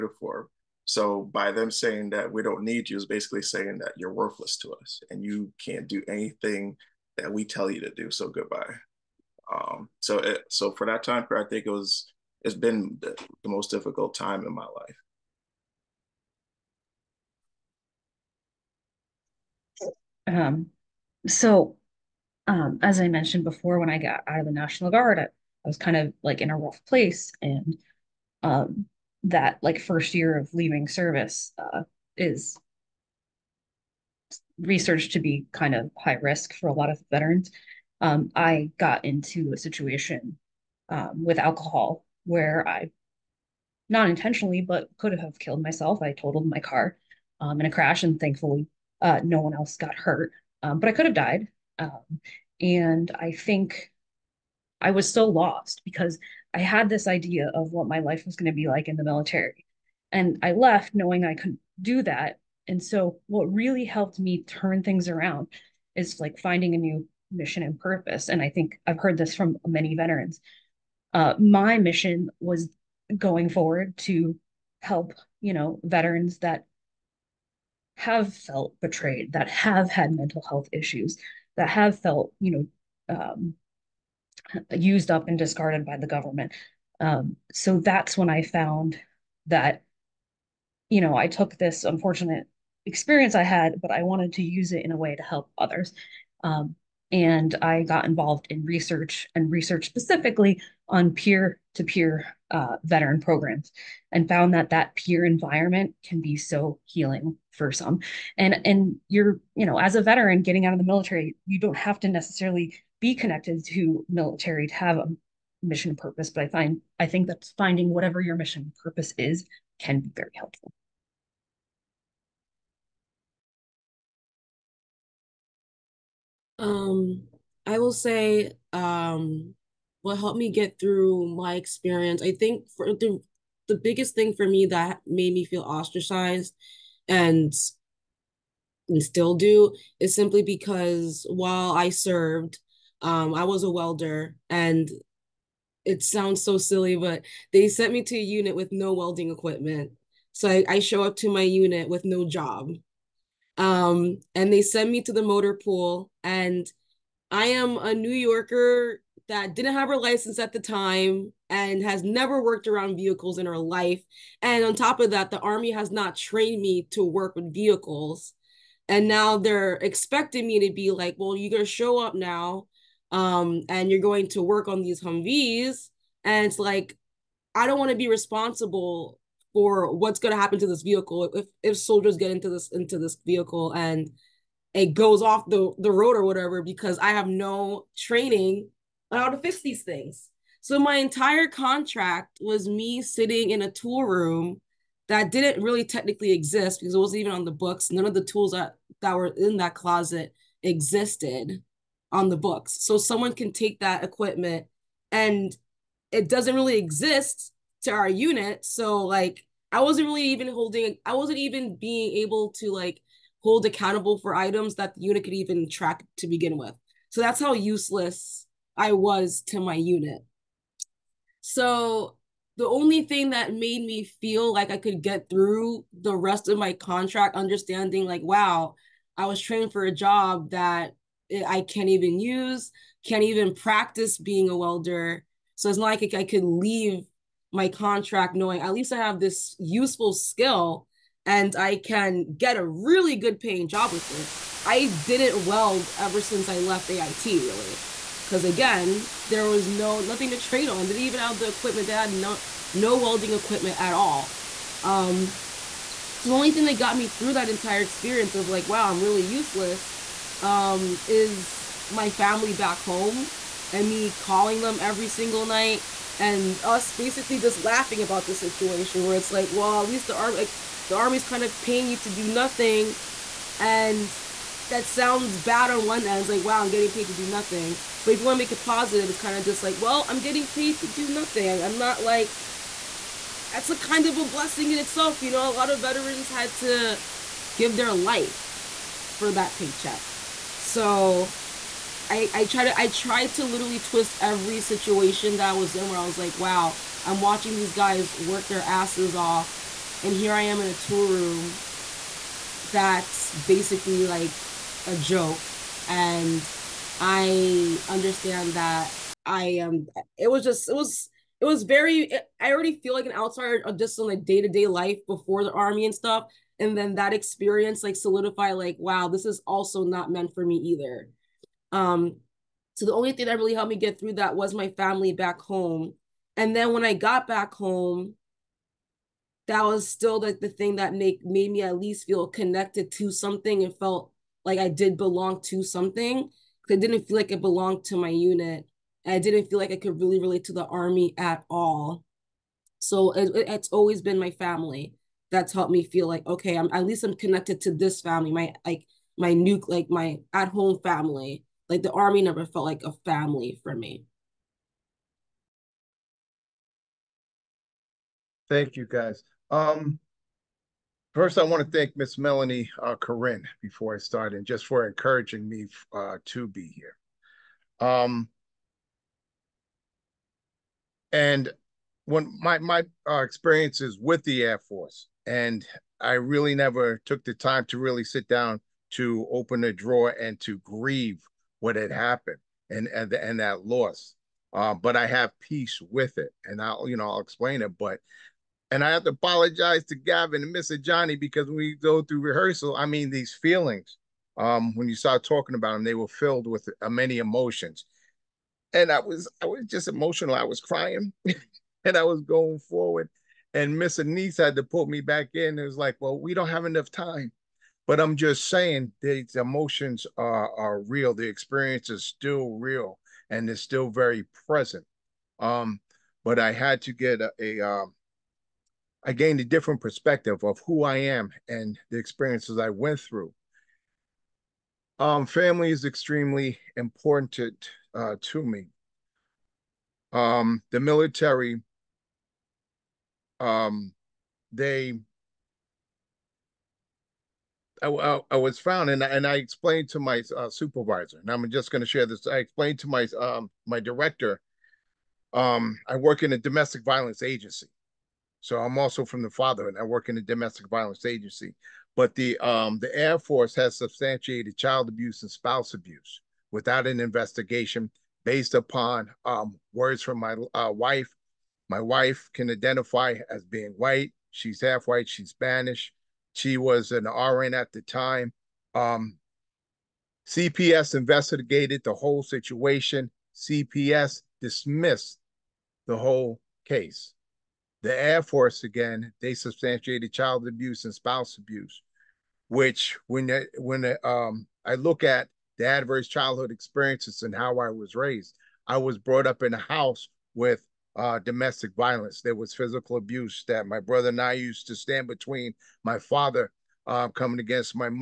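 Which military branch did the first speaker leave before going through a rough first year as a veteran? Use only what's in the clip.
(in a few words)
National Guard.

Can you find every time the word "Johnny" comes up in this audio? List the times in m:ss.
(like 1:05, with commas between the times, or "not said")
6:30.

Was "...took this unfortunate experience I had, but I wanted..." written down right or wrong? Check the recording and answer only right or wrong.
right.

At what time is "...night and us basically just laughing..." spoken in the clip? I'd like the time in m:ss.
4:25.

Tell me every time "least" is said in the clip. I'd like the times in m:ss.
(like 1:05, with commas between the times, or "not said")
3:58, 4:29, 5:31, 5:46.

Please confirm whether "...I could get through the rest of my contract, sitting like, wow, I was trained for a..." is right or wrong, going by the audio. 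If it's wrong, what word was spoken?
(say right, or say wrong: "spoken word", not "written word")
wrong: "understanding", not "sitting".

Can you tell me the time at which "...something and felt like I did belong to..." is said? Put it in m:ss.
5:33.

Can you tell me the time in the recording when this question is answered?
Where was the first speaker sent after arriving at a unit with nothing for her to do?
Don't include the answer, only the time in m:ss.
2:35.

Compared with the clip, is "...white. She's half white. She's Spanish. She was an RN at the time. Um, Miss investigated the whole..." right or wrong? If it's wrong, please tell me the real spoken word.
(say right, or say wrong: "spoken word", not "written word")
wrong: "CPS", not "Miss".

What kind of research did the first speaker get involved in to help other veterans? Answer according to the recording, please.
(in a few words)
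Peer to peer veteran programs.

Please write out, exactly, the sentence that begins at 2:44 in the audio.
And on top of that, the Army has not trained me to work with vehicles.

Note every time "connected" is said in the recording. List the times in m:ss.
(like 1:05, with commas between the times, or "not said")
1:53, 5:32, 5:47.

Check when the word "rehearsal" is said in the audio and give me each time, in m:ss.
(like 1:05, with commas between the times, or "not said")
6:32.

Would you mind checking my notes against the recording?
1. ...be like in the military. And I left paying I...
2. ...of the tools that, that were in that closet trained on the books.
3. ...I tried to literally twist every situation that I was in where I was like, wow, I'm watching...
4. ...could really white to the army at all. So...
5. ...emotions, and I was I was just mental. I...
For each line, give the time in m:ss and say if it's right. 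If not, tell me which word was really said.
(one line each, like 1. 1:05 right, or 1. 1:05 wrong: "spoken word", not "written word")
1. 0:58 wrong: "knowing", not "paying"
2. 3:18 wrong: "existed", not "trained"
3. 4:52 right
4. 5:39 wrong: "relate", not "white"
5. 6:37 wrong: "emotional", not "mental".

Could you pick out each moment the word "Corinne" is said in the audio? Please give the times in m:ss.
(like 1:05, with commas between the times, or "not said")
6:02.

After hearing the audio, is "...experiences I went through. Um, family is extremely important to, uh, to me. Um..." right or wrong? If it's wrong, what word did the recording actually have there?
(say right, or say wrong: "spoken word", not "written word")
right.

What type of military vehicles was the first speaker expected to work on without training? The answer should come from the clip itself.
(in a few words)
Humvees.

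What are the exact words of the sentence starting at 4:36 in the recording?
It's like, wow, I'm getting paid to do nothing.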